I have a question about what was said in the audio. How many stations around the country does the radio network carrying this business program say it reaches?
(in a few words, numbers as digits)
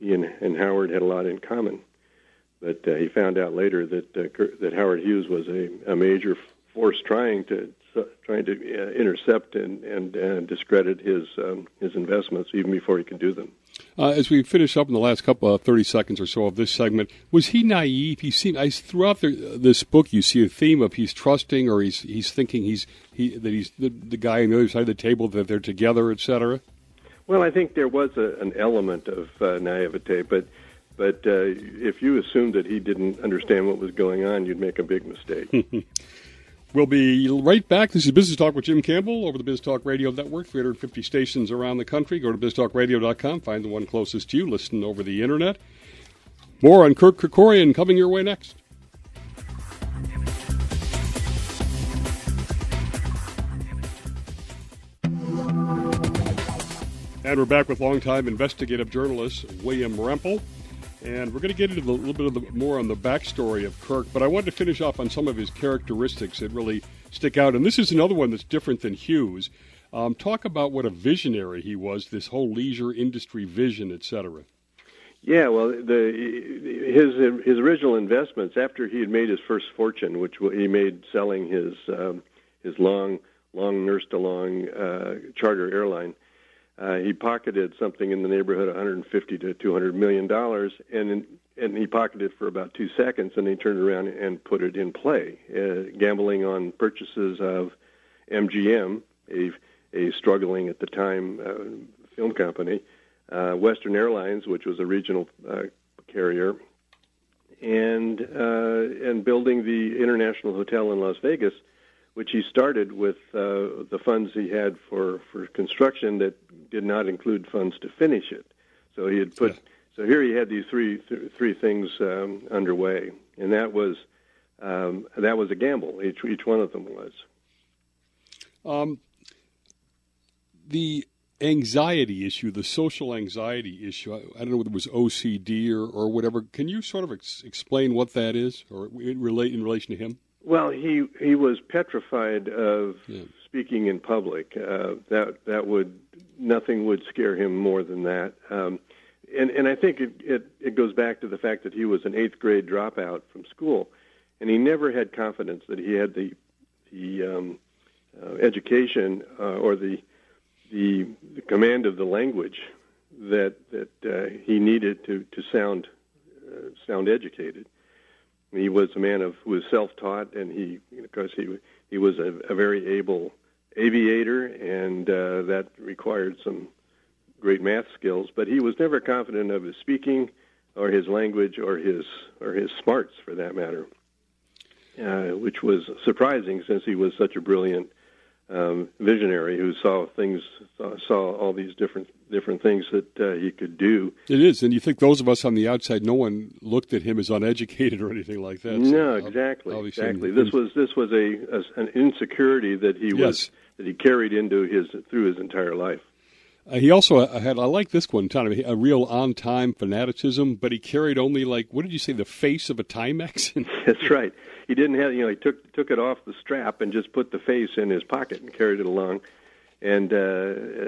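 350.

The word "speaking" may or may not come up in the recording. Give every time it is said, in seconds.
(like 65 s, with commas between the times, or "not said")
143 s, 179 s.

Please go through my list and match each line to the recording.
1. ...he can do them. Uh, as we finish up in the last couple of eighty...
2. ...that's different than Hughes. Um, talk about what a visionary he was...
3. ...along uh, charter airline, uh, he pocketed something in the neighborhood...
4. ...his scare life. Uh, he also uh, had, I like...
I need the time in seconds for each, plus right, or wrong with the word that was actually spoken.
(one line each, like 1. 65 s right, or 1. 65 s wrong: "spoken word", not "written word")
1. 12 s wrong: "thirty", not "eighty"
2. 68 s right
3. 84 s right
4. 205 s wrong: "entire", not "scare".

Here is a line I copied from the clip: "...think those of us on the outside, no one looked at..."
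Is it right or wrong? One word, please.
right.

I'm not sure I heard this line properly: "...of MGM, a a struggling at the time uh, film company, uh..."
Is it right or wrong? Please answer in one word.
right.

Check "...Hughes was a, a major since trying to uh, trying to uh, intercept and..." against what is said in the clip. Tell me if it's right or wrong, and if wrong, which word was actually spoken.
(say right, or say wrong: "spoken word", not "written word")
wrong: "force", not "since".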